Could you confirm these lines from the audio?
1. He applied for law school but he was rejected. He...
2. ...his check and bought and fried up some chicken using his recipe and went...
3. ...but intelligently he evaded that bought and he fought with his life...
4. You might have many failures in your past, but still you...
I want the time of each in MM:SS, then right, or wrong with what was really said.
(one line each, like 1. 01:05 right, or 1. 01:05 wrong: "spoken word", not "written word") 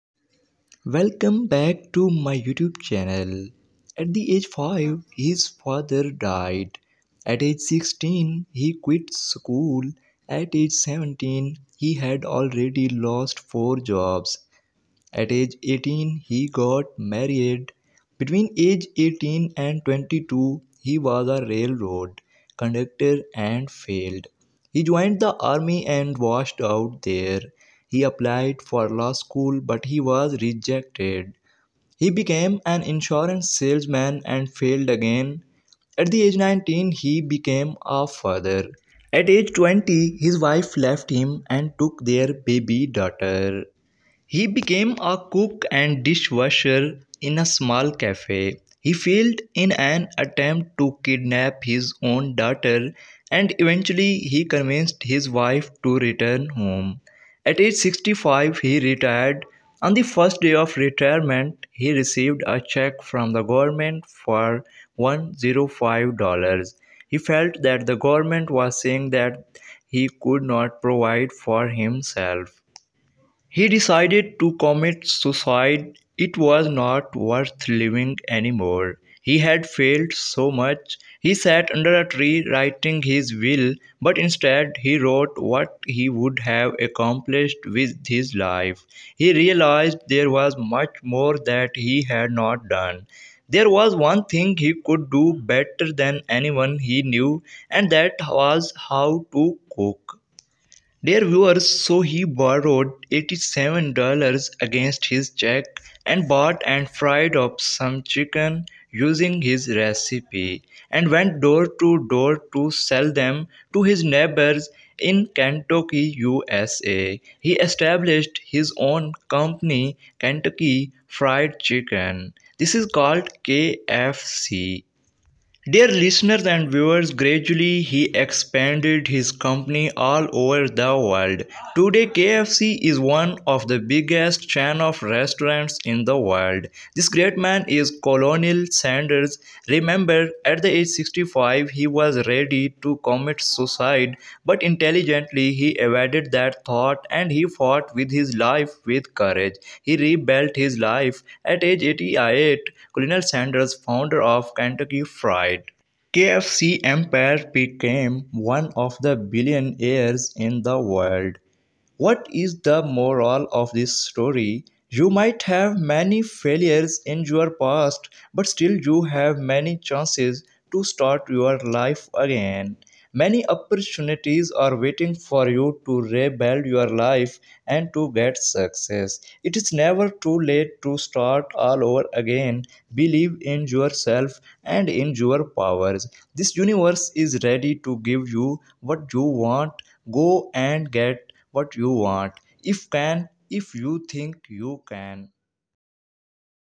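1. 00:27 right
2. 01:45 right
3. 02:24 wrong: "thought", not "bought"
4. 02:44 right.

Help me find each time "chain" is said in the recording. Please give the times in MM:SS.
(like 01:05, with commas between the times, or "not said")
02:14.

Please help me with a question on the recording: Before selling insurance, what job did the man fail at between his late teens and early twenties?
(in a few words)
railroad conductor.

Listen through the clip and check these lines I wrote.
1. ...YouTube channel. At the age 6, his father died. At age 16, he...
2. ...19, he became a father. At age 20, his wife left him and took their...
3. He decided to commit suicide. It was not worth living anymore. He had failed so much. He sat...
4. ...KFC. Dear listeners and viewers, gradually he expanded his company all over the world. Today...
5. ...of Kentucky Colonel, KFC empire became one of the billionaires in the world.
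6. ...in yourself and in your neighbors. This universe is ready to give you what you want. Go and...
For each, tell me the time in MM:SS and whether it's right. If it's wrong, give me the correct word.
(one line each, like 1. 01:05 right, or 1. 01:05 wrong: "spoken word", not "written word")
1. 00:02 wrong: "5", not "6"
2. 00:36 right
3. 01:13 right
4. 02:03 right
5. 02:34 wrong: "Fried", not "Colonel"
6. 03:03 wrong: "powers", not "neighbors".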